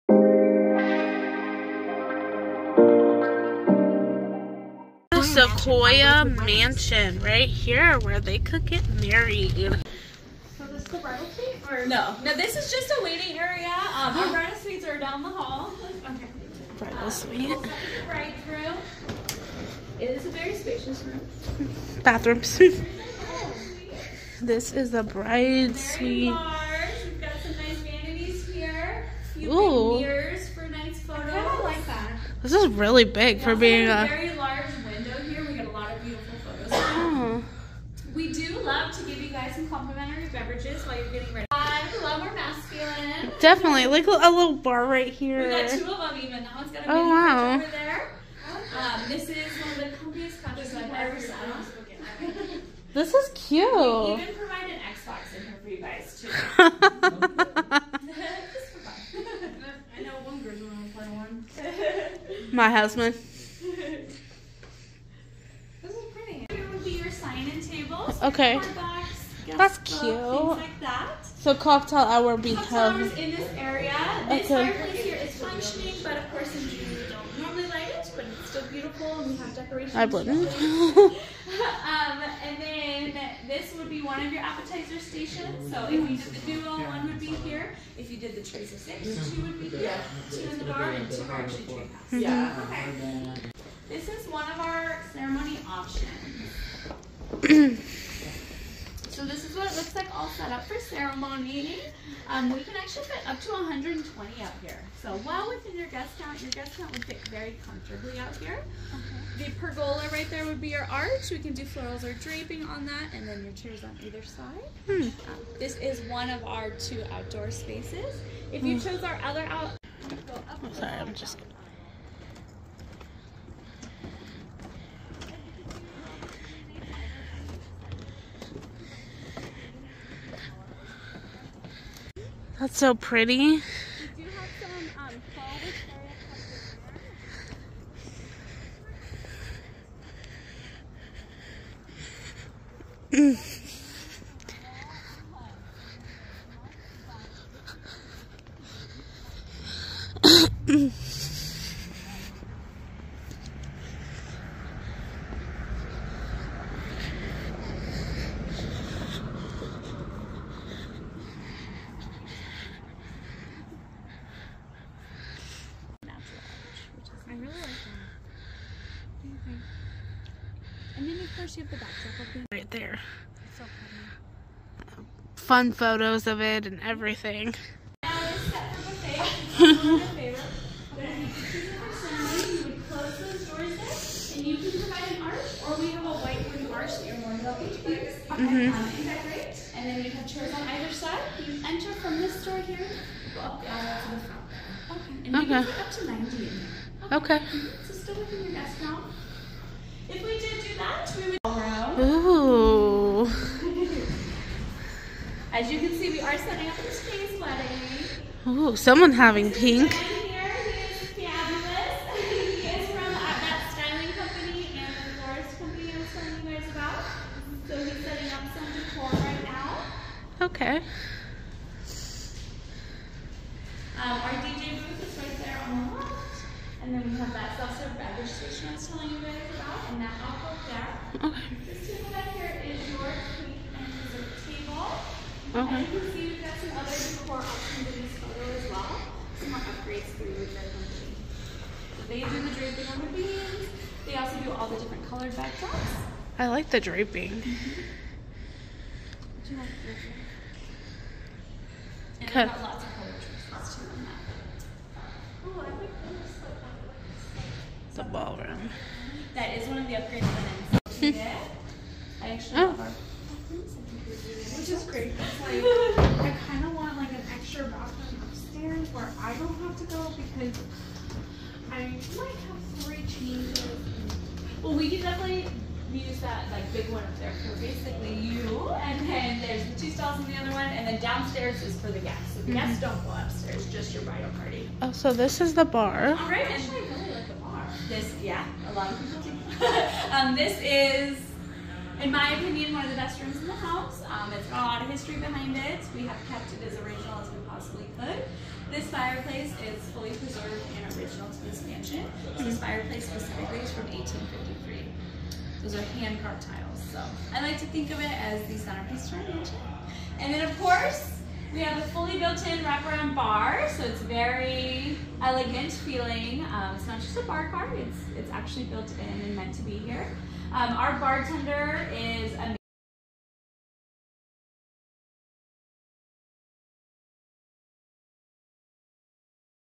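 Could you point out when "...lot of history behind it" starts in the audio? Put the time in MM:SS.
04:54.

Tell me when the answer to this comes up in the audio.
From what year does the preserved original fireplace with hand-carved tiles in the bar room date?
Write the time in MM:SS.
05:03.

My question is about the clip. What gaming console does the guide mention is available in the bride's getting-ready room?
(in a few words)
Xbox.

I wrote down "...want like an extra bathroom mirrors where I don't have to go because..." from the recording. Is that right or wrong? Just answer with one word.
wrong.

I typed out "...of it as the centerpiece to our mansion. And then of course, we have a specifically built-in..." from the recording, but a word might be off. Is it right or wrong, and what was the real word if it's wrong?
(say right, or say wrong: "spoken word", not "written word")
wrong: "fully", not "specifically".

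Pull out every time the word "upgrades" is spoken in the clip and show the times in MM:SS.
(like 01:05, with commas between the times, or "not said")
03:59, 04:19.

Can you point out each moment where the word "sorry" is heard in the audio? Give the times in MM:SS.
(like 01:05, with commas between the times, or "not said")
02:00.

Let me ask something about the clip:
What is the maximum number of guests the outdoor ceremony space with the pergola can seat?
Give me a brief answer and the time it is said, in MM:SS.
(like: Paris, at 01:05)
120, at 01:43.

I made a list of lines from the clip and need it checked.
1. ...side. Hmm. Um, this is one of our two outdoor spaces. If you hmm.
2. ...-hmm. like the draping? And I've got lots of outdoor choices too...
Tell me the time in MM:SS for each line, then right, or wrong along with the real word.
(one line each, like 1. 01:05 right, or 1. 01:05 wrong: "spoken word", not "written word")
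1. 01:54 right
2. 04:07 wrong: "color", not "outdoor".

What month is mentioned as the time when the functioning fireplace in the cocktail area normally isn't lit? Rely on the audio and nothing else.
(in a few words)
June.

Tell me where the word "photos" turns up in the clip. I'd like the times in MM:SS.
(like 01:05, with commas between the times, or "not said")
00:30, 03:58.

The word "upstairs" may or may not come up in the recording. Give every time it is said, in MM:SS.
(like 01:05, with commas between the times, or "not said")
04:28, 04:43.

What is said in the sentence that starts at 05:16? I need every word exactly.
Um, it's not just a bar card, it's, it's actually built in and meant to be here.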